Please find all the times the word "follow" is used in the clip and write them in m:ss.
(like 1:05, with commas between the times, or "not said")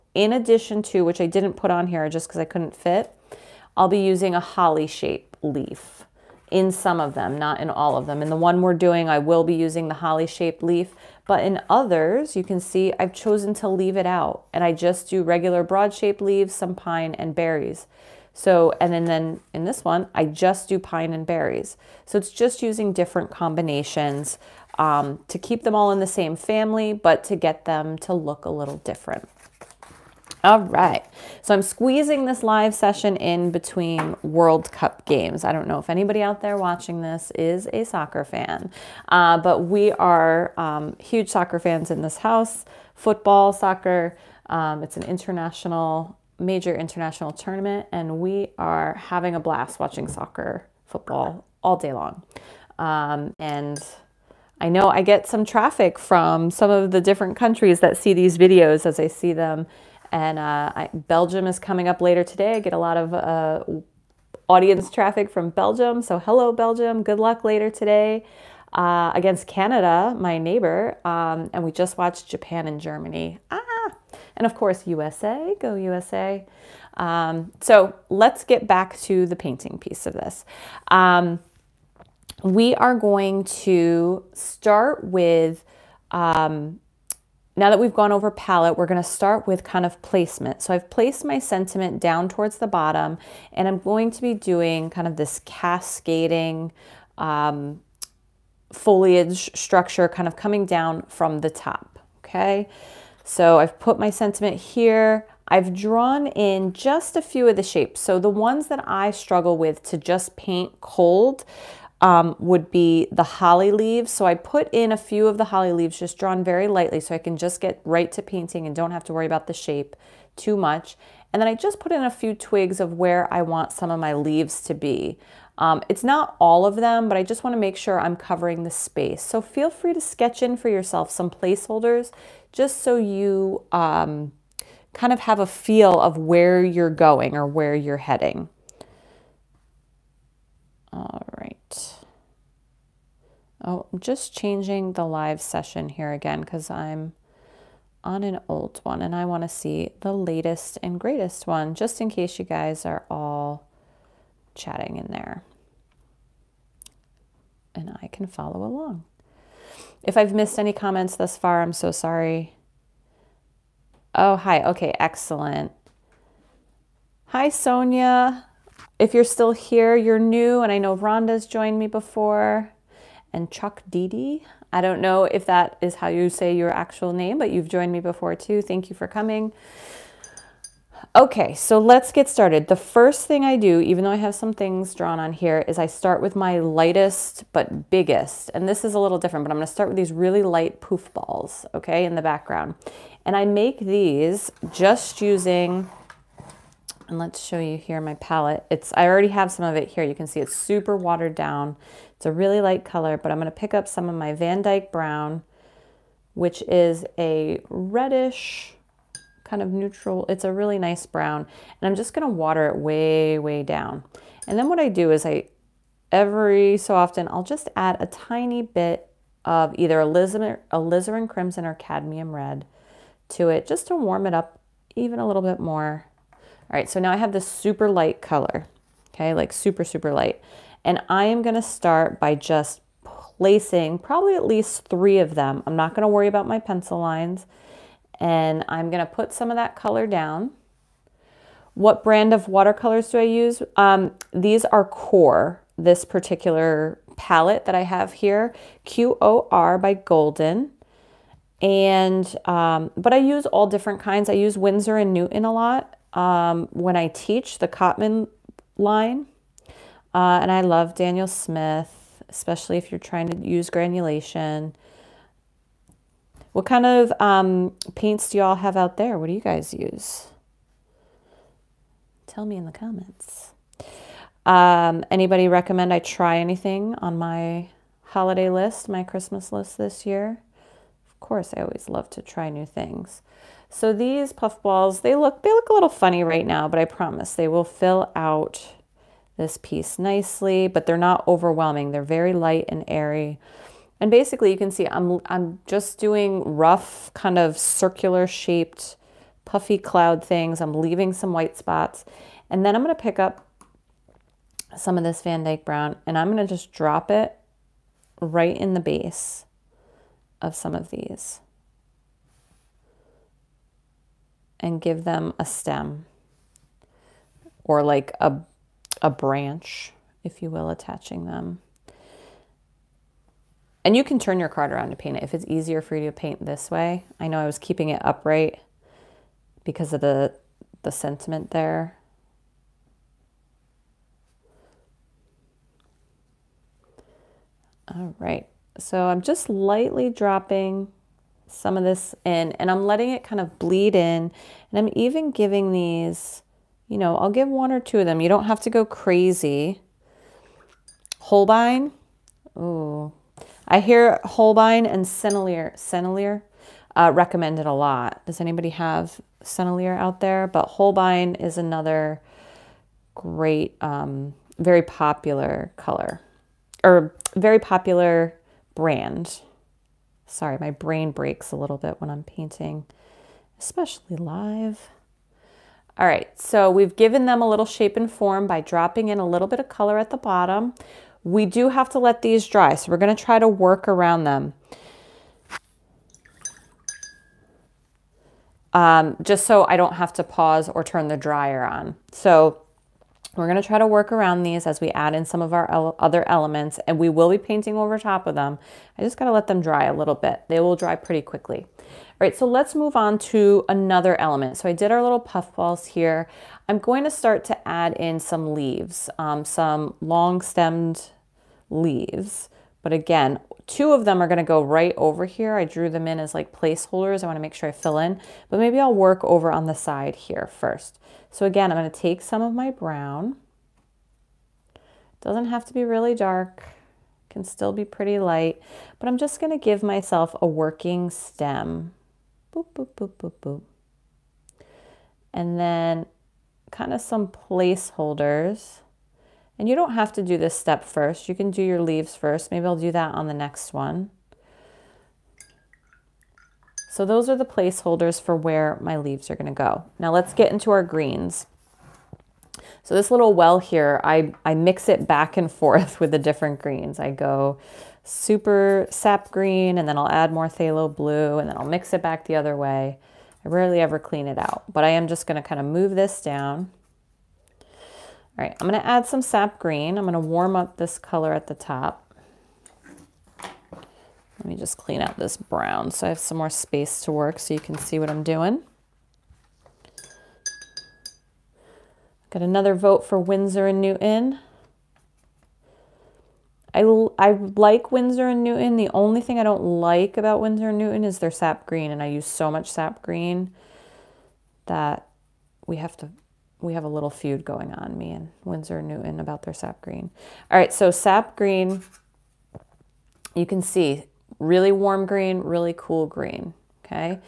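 2:38.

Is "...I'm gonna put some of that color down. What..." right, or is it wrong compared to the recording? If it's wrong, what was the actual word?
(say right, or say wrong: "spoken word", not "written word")
right.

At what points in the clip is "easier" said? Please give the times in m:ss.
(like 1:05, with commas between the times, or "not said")
5:25.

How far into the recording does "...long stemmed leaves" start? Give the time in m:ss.
6:49.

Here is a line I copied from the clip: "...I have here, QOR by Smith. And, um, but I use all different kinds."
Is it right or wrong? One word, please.
wrong.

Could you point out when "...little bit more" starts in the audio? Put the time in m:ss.
3:45.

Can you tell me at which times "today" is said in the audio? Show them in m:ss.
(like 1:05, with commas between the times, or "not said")
1:02, 1:07.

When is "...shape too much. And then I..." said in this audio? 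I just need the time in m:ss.
1:59.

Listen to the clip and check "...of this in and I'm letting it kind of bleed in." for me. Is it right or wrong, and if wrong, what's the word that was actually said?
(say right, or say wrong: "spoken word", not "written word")
right.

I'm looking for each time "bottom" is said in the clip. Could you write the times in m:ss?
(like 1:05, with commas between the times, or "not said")
1:32, 6:20.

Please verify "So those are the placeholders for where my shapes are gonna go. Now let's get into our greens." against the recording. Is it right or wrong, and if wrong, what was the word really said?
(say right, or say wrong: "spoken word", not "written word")
wrong: "leaves", not "shapes".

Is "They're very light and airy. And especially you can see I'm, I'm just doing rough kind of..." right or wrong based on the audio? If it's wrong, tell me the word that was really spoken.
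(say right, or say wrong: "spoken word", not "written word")
wrong: "basically", not "especially".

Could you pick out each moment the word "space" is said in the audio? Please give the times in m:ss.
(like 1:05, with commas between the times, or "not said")
2:08, 7:56.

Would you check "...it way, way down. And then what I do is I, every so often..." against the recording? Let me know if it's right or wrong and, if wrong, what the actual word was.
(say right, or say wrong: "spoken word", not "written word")
right.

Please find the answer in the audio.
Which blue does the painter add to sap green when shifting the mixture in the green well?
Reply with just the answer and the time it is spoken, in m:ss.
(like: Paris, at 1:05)
Phthalo blue, at 7:40.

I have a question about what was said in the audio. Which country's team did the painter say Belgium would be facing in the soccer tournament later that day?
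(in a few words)
Canada.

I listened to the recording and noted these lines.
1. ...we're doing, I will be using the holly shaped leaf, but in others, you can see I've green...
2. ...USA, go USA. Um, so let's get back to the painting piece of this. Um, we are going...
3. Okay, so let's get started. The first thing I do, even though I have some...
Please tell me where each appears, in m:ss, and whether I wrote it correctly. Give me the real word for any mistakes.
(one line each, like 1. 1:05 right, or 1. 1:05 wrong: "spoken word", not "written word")
1. 0:08 wrong: "chosen", not "green"
2. 1:14 right
3. 3:01 right.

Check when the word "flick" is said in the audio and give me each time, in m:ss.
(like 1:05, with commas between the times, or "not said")
not said.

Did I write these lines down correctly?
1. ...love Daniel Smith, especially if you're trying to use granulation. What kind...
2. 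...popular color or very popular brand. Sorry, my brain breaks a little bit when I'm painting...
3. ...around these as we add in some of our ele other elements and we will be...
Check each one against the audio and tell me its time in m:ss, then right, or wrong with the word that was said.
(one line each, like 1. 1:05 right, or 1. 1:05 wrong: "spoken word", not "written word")
1. 4:20 right
2. 6:04 right
3. 6:34 right.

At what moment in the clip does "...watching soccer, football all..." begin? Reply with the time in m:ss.
0:49.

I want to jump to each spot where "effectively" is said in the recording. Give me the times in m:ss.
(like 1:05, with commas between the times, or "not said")
not said.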